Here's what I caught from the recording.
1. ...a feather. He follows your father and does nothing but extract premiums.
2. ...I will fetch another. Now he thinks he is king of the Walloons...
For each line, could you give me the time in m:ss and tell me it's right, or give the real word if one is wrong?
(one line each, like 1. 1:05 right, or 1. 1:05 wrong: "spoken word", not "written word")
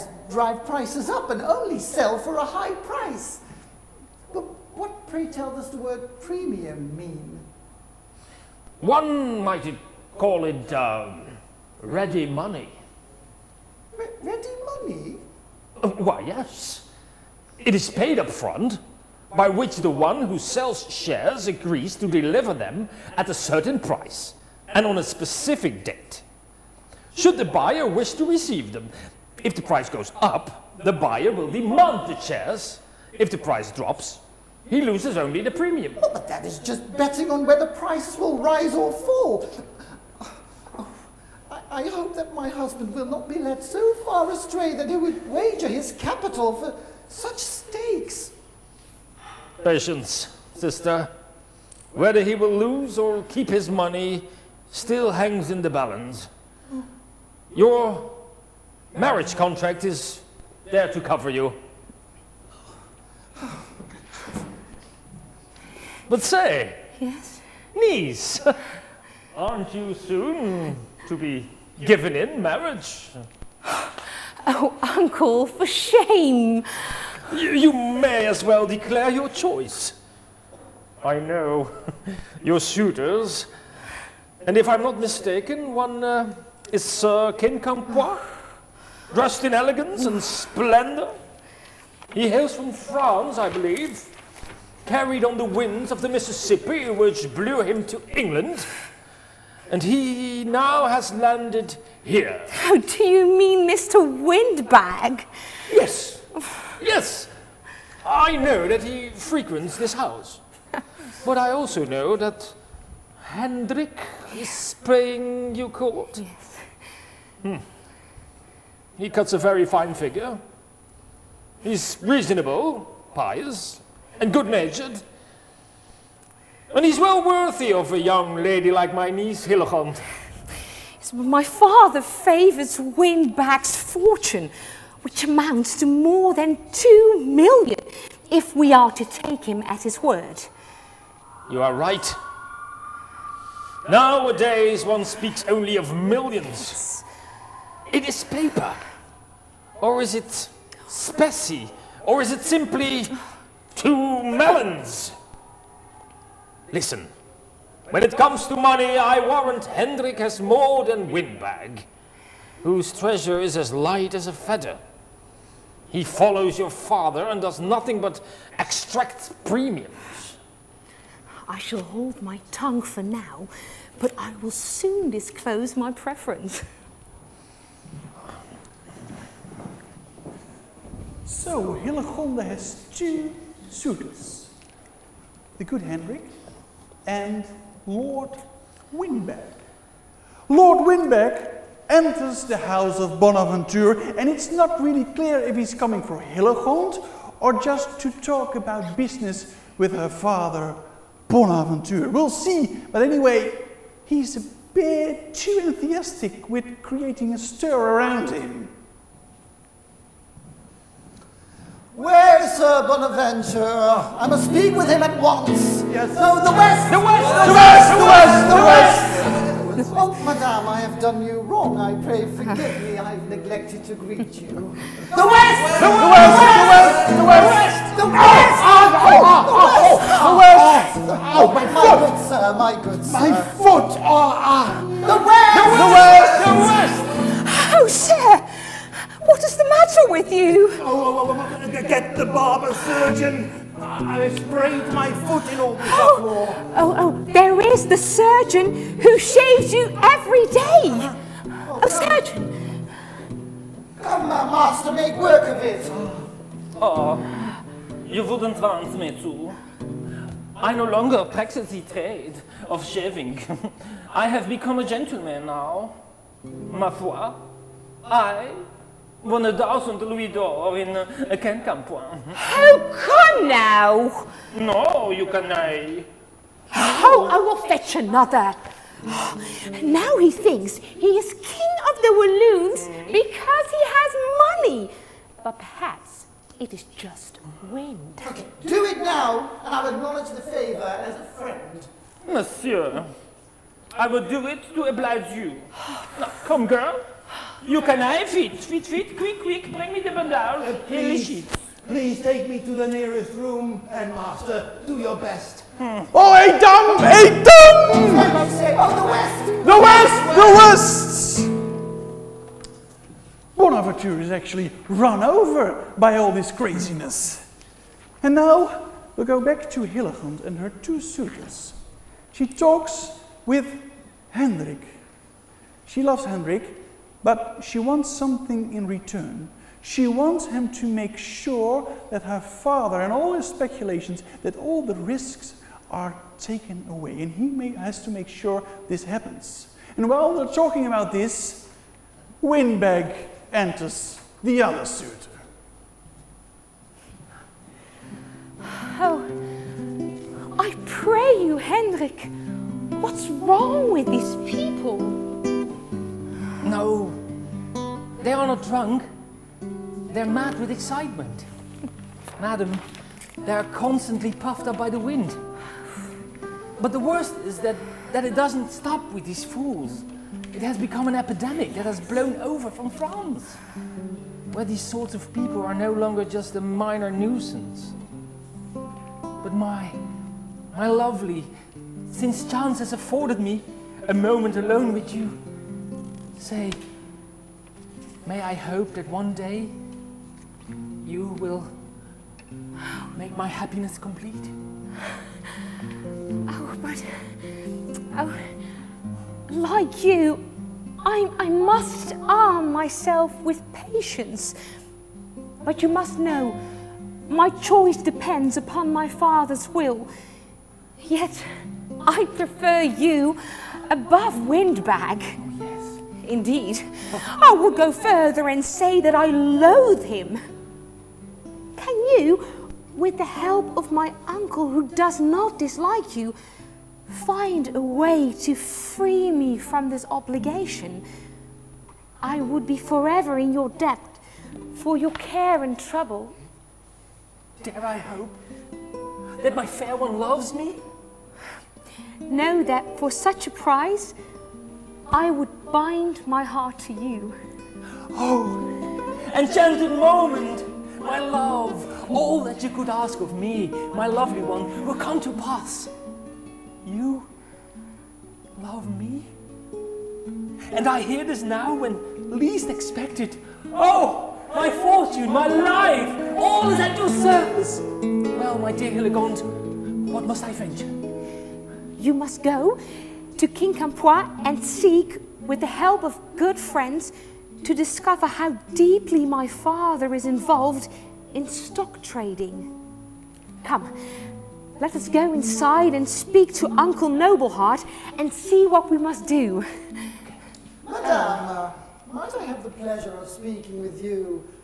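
1. 2:44 right
2. 4:37 right.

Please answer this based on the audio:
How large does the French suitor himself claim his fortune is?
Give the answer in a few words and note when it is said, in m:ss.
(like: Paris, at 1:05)
more than two million, at 2:15.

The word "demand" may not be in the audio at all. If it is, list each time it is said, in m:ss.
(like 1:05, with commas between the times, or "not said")
0:31.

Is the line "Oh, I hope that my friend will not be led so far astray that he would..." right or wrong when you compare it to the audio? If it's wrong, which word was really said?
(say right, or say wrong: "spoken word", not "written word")
wrong: "husband", not "friend".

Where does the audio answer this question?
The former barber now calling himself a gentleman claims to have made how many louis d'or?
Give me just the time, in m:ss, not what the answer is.
4:29.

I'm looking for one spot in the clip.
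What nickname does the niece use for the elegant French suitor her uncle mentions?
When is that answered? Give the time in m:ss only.
1:43.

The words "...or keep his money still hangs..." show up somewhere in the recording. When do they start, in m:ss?
0:52.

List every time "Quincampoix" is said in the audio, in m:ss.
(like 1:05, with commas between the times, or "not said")
1:27, 4:31, 7:53.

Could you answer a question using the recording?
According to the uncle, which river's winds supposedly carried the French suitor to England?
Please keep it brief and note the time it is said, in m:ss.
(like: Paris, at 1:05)
Mississippi, at 1:36.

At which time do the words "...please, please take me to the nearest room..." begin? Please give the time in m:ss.
5:00.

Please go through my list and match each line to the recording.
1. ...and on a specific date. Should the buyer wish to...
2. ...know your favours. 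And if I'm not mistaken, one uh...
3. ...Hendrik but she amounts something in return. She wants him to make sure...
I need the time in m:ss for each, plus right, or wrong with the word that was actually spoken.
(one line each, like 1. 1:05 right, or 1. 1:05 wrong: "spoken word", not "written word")
1. 0:24 right
2. 1:21 wrong: "suitors", not "favours"
3. 5:26 wrong: "wants", not "amounts".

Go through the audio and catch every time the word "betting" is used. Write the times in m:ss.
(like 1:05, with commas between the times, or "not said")
0:36.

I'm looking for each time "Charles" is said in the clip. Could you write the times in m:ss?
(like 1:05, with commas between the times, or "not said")
not said.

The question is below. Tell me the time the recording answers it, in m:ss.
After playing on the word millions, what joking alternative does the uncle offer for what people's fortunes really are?
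2:33.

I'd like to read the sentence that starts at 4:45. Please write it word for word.
But perhaps it is just wind.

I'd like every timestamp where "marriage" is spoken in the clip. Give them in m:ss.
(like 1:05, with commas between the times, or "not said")
0:58, 1:12.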